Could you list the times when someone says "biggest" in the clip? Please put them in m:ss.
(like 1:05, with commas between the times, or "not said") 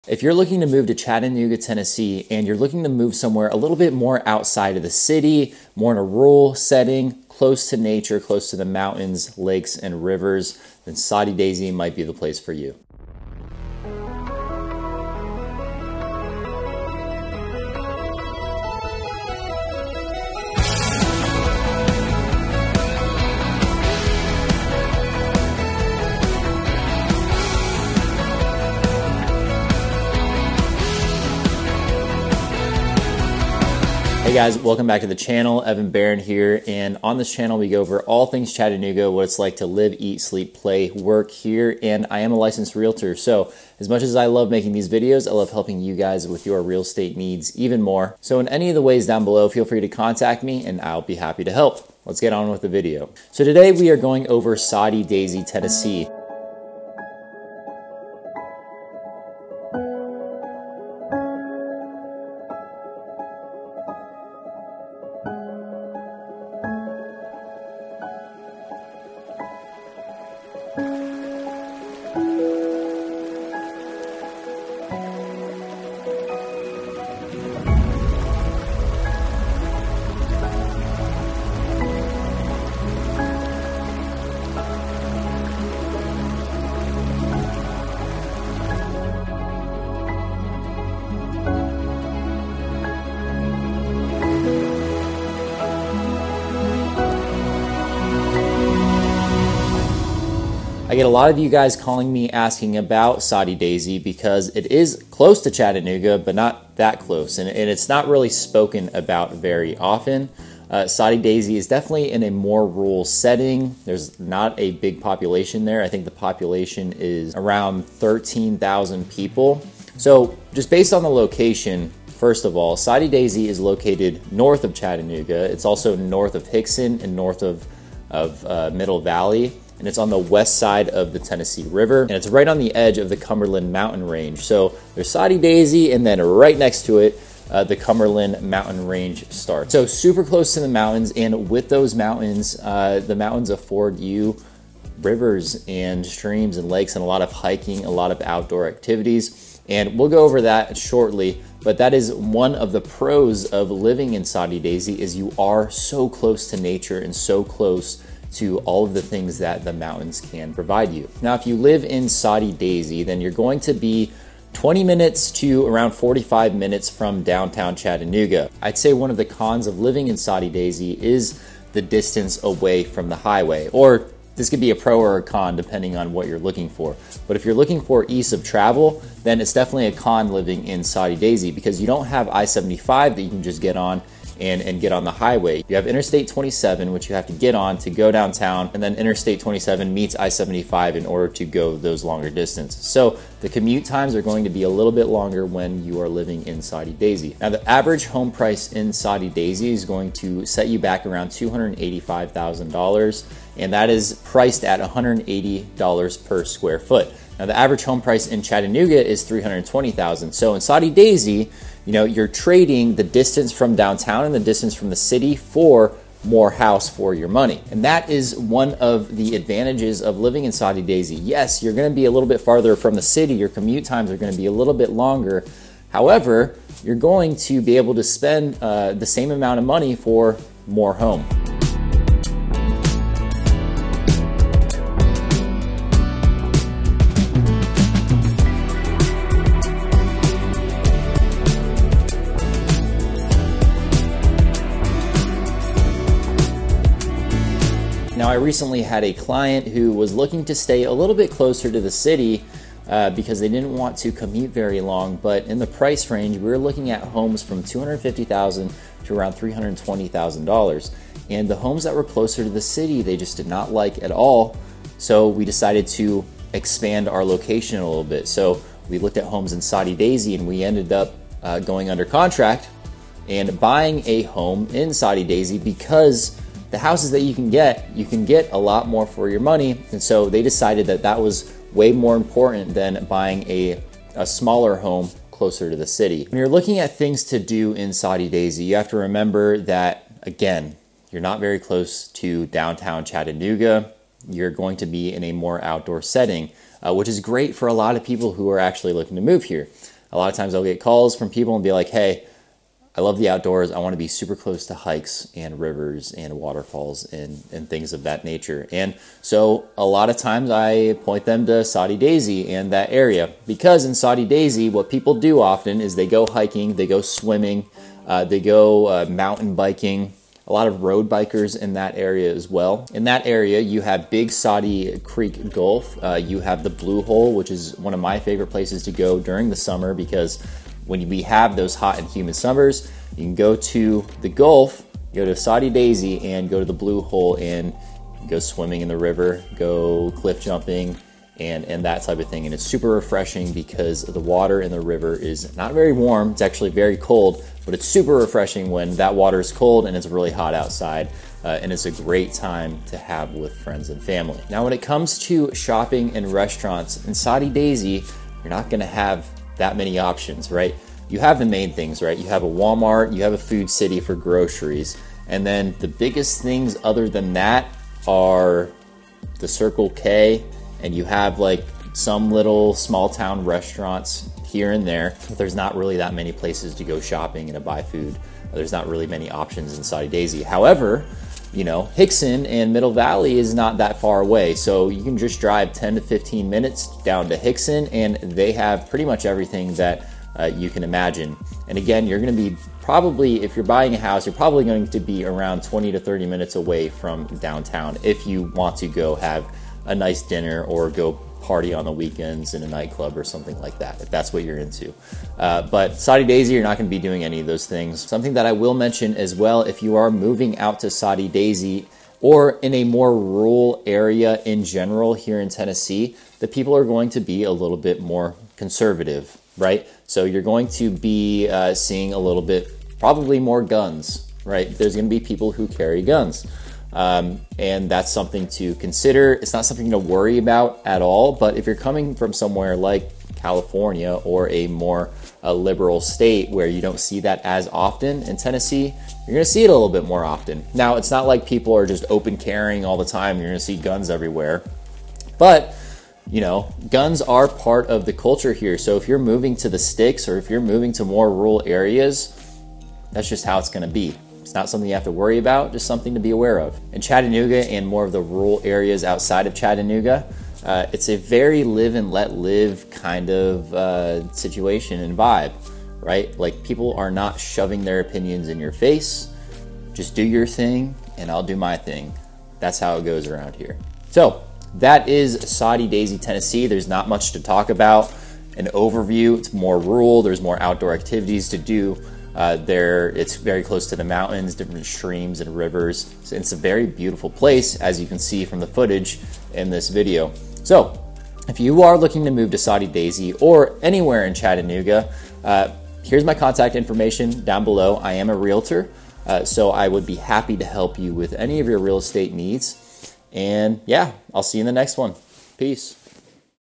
6:05.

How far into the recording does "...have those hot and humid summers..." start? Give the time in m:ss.
5:31.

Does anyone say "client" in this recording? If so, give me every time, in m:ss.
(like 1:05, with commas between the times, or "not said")
4:09.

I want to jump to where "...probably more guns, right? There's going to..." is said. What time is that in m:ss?
7:02.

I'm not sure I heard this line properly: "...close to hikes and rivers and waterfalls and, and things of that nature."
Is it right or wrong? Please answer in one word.
right.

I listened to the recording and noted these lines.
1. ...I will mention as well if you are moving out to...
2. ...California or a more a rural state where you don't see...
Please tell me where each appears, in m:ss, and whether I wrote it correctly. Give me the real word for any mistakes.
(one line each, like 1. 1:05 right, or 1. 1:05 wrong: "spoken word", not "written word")
1. 6:48 right
2. 7:13 wrong: "liberal", not "rural".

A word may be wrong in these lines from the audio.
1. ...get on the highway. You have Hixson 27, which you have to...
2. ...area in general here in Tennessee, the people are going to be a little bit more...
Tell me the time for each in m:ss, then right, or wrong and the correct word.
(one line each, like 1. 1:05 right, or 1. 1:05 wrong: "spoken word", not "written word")
1. 3:04 wrong: "Interstate", not "Hixson"
2. 6:53 right.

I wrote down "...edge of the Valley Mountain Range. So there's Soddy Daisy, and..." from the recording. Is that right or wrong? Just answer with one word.
wrong.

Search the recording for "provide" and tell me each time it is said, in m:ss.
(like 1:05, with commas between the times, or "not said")
2:40.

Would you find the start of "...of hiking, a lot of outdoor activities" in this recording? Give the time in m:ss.
2:27.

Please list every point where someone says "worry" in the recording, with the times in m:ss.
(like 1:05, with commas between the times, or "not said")
7:09, 7:35.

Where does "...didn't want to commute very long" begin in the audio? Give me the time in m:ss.
4:13.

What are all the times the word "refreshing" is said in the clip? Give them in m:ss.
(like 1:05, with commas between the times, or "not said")
5:42, 5:48.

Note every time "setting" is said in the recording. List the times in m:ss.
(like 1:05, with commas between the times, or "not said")
0:06, 1:53, 4:56.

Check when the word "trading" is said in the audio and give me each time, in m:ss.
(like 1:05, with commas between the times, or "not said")
3:32.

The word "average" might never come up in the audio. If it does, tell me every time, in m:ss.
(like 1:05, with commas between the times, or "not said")
3:17, 3:27.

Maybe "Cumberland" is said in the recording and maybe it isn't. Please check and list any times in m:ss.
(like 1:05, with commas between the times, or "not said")
2:13, 2:17.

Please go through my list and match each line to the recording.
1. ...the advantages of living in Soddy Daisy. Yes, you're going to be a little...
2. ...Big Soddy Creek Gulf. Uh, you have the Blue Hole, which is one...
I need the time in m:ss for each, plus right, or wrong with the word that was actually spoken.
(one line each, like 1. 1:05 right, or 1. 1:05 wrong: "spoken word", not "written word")
1. 3:39 right
2. 5:24 right.